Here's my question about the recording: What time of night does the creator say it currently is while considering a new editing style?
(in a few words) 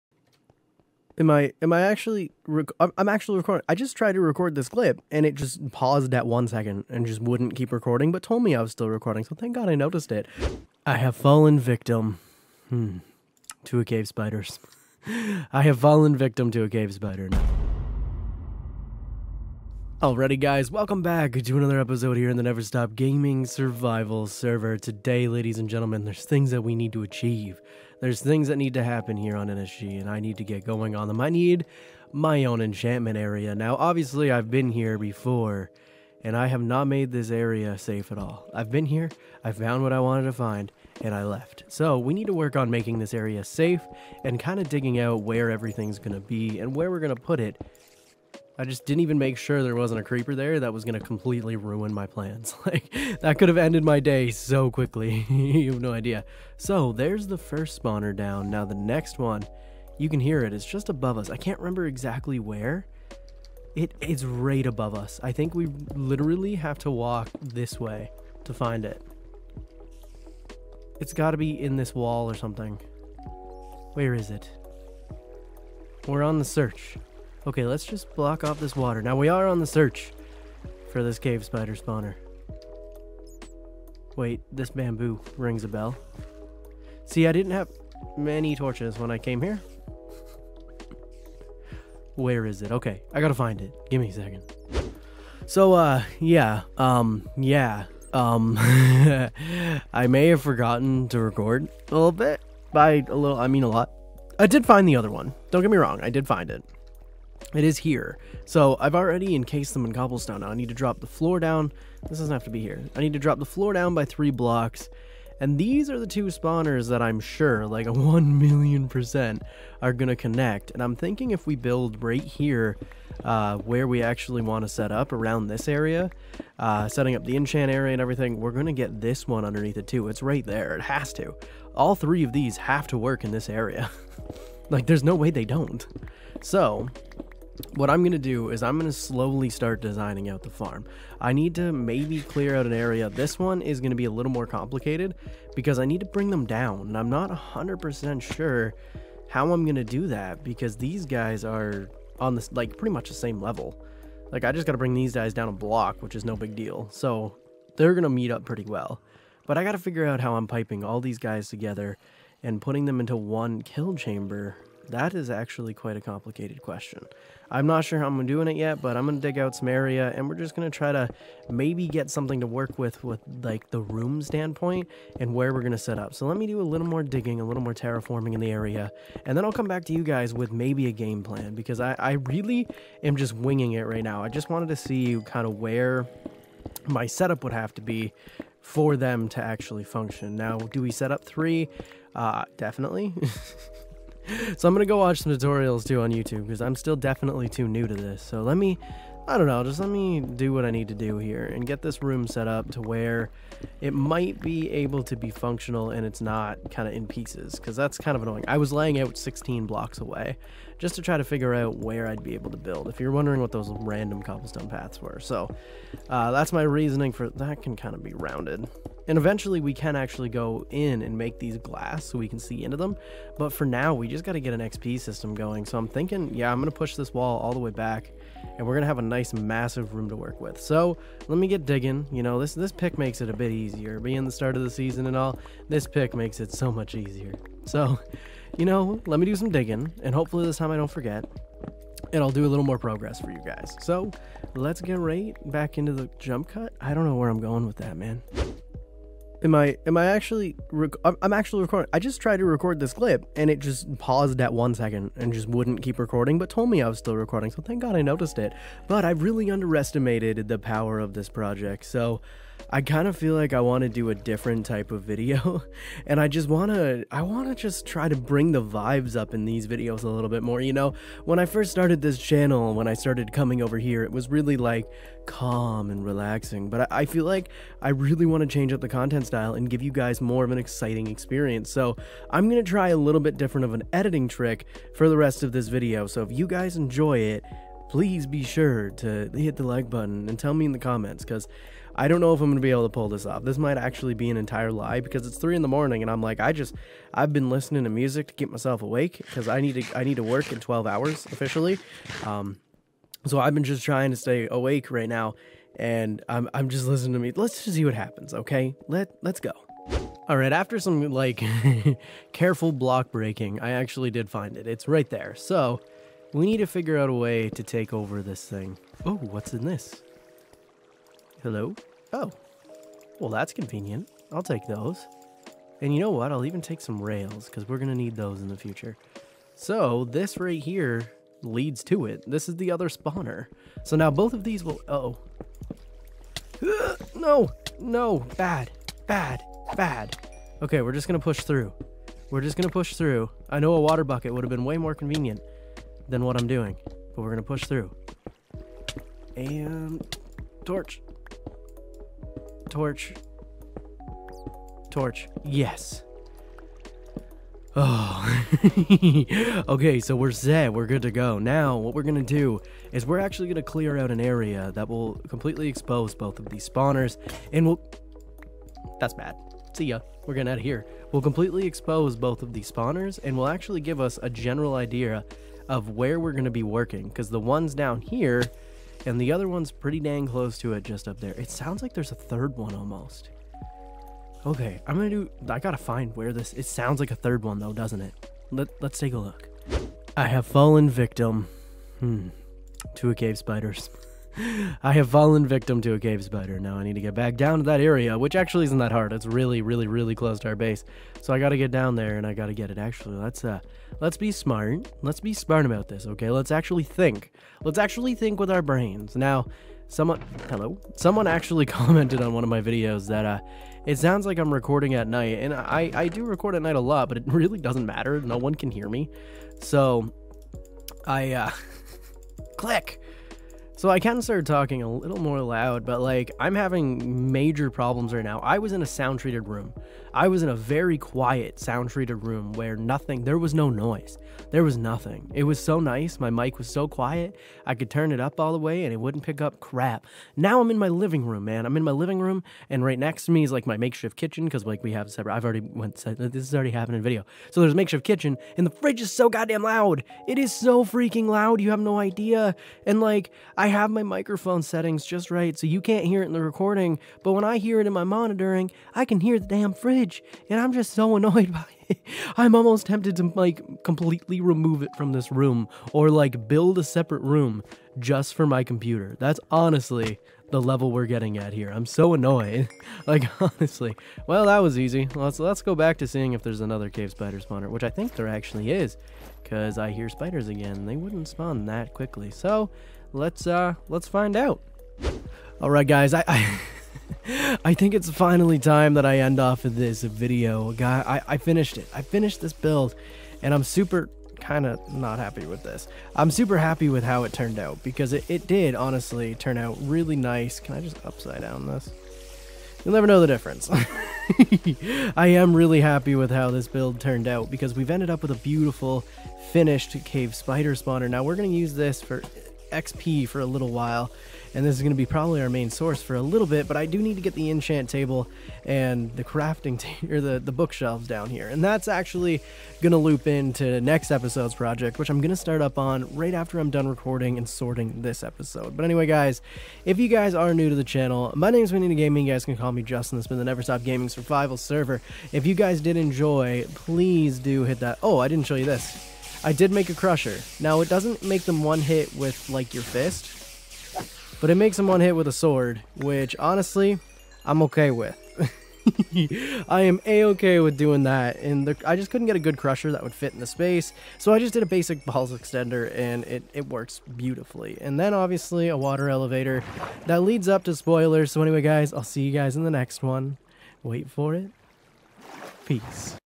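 3 in the morning.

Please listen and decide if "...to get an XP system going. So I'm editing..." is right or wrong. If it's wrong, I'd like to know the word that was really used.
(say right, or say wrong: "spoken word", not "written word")
wrong: "thinking", not "editing".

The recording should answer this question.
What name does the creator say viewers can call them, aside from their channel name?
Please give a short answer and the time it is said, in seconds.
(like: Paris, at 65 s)
Justin, at 532 s.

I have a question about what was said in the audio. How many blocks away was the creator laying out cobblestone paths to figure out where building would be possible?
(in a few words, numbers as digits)
16.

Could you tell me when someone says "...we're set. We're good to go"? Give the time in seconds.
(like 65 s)
360 s.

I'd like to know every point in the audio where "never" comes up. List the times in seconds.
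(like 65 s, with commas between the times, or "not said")
22 s, 502 s, 533 s.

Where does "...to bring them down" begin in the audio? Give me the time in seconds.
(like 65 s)
145 s.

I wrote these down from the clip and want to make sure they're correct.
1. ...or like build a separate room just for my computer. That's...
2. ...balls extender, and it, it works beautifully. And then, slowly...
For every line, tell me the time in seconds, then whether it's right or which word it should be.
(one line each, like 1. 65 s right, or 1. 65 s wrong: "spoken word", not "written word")
1. 465 s right
2. 555 s wrong: "obviously", not "slowly".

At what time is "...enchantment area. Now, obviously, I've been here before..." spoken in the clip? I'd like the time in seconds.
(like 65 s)
32 s.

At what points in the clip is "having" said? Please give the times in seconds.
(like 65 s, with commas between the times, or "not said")
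426 s.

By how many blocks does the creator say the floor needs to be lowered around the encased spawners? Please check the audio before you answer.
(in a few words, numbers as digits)
3.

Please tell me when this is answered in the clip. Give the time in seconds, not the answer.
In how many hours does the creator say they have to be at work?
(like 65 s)
300 s.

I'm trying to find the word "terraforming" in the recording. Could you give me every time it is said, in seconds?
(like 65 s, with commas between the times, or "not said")
177 s.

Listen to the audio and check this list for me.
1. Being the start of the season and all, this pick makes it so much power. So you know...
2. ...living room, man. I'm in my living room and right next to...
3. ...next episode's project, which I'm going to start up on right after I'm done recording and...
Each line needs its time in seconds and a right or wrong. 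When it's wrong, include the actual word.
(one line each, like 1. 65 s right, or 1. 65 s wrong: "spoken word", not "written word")
1. 233 s wrong: "easier", not "power"
2. 440 s right
3. 523 s right.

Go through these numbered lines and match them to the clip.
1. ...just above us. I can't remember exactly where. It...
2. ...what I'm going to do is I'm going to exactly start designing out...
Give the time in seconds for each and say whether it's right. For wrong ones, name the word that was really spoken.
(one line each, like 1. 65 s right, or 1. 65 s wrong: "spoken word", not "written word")
1. 60 s right
2. 137 s wrong: "slowly", not "exactly".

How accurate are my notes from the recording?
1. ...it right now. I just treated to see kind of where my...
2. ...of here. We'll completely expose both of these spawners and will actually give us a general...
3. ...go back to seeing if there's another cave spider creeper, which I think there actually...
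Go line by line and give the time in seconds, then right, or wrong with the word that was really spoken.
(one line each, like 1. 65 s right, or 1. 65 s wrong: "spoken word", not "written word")
1. 183 s wrong: "wanted", not "treated"
2. 370 s right
3. 475 s wrong: "spawner", not "creeper".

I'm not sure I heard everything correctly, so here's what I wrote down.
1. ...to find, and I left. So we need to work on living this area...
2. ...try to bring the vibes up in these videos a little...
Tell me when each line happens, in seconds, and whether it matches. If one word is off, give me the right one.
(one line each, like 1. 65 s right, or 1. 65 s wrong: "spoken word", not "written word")
1. 40 s wrong: "making", not "living"
2. 267 s right.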